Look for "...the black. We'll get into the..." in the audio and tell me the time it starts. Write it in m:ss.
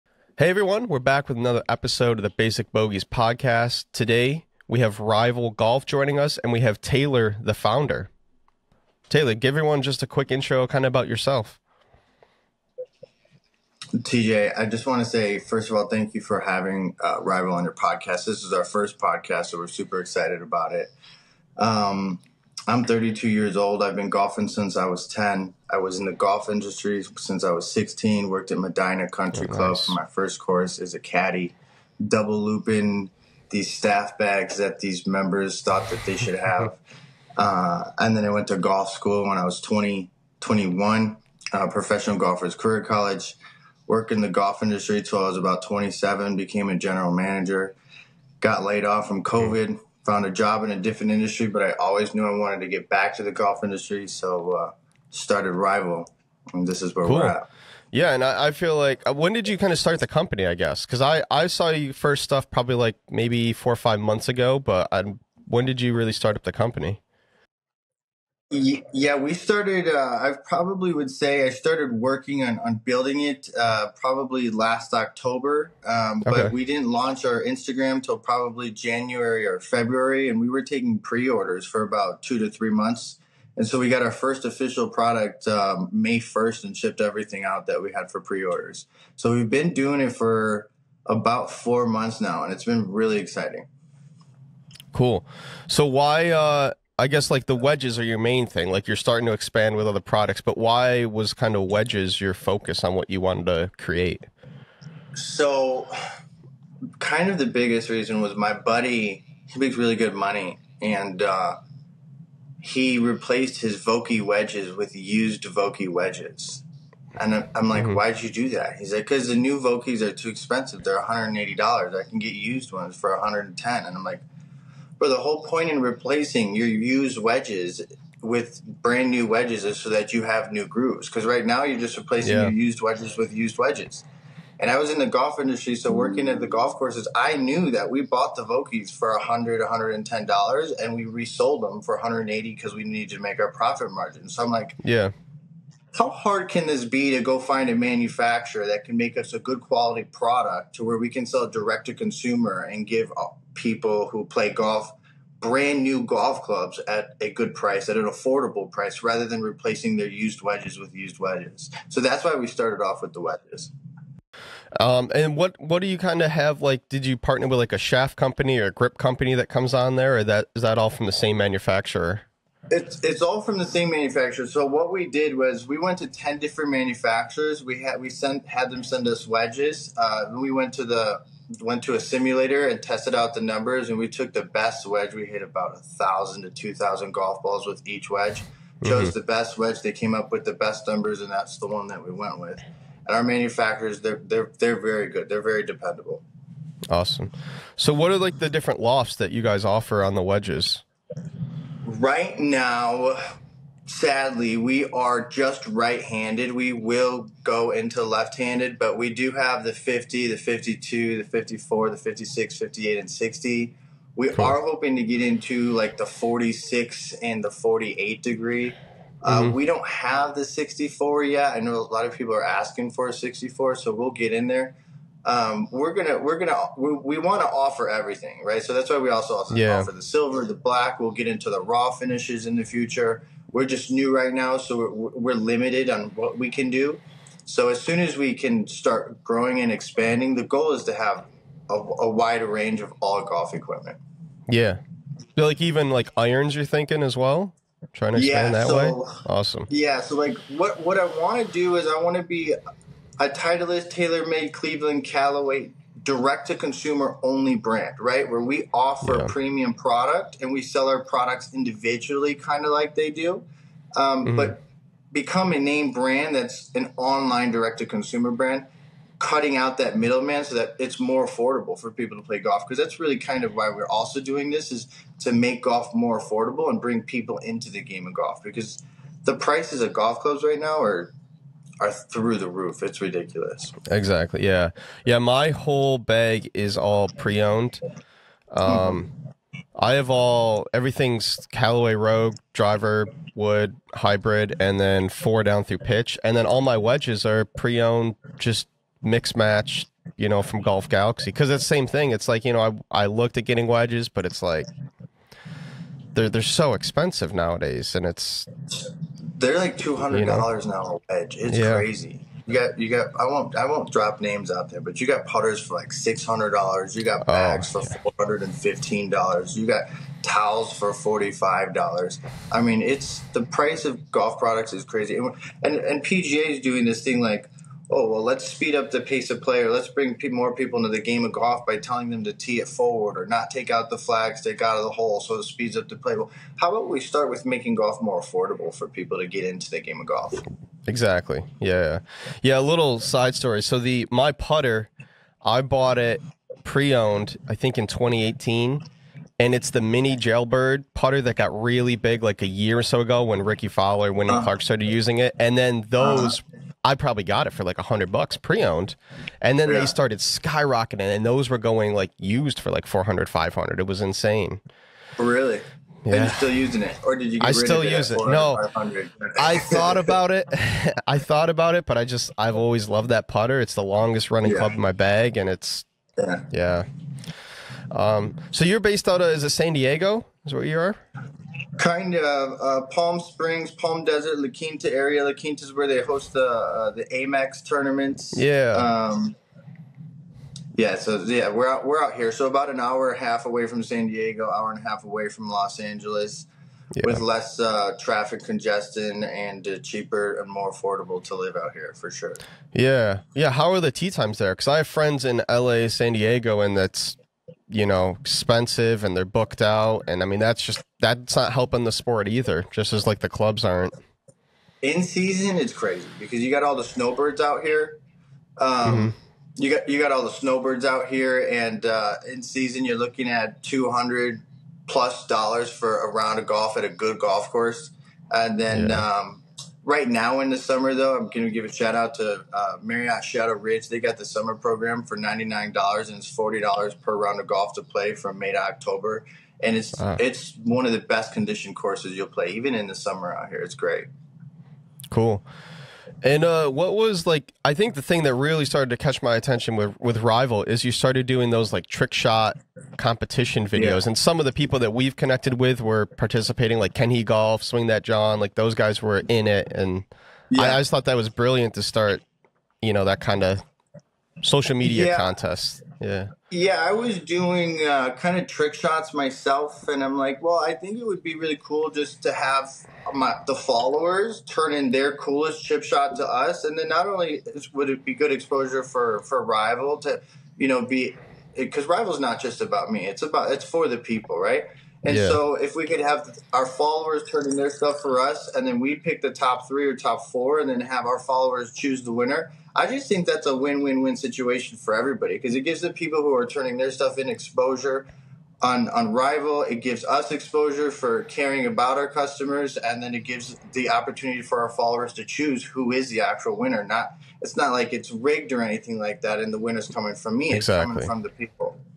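3:50.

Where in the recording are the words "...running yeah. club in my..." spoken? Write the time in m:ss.
6:14.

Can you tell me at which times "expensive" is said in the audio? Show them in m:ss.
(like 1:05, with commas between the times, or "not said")
2:00, 5:06, 6:48.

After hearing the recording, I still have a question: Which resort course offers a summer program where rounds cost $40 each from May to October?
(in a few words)
Marriott Shadow Ridge.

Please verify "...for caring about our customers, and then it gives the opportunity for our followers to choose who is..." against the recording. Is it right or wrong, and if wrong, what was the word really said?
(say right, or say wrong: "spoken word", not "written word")
right.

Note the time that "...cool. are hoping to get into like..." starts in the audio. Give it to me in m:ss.
3:34.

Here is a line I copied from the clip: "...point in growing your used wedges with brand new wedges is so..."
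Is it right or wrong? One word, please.
wrong.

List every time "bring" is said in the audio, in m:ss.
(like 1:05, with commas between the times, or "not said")
4:36, 5:29.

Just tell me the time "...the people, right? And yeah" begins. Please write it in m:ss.
8:03.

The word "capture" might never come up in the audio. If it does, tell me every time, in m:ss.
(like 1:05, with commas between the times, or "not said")
not said.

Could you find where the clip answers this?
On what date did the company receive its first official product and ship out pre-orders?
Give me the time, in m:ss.
1:25.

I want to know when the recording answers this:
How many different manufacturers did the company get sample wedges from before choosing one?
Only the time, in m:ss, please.
2:56.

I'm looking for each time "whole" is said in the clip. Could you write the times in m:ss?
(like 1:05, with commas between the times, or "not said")
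2:05, 4:45.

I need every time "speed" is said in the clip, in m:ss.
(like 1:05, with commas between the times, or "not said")
5:28, 5:35.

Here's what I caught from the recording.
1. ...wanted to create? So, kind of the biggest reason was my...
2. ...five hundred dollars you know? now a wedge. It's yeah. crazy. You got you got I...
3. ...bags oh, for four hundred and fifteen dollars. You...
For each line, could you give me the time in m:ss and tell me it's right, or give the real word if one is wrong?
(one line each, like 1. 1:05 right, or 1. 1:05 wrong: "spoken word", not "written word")
1. 1:43 right
2. 5:09 wrong: "two", not "five"
3. 5:17 right.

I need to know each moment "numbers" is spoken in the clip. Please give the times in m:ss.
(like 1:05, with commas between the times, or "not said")
3:03, 3:10.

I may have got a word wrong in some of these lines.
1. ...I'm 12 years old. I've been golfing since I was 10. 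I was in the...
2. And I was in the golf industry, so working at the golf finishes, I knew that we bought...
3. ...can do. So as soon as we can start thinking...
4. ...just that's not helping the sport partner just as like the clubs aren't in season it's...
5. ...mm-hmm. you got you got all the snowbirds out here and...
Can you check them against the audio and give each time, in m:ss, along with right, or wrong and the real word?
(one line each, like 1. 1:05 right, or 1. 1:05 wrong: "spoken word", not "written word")
1. 0:22 wrong: "32", not "12"
2. 2:14 wrong: "courses", not "finishes"
3. 3:56 wrong: "growing", not "thinking"
4. 6:50 wrong: "either", not "partner"
5. 6:58 right.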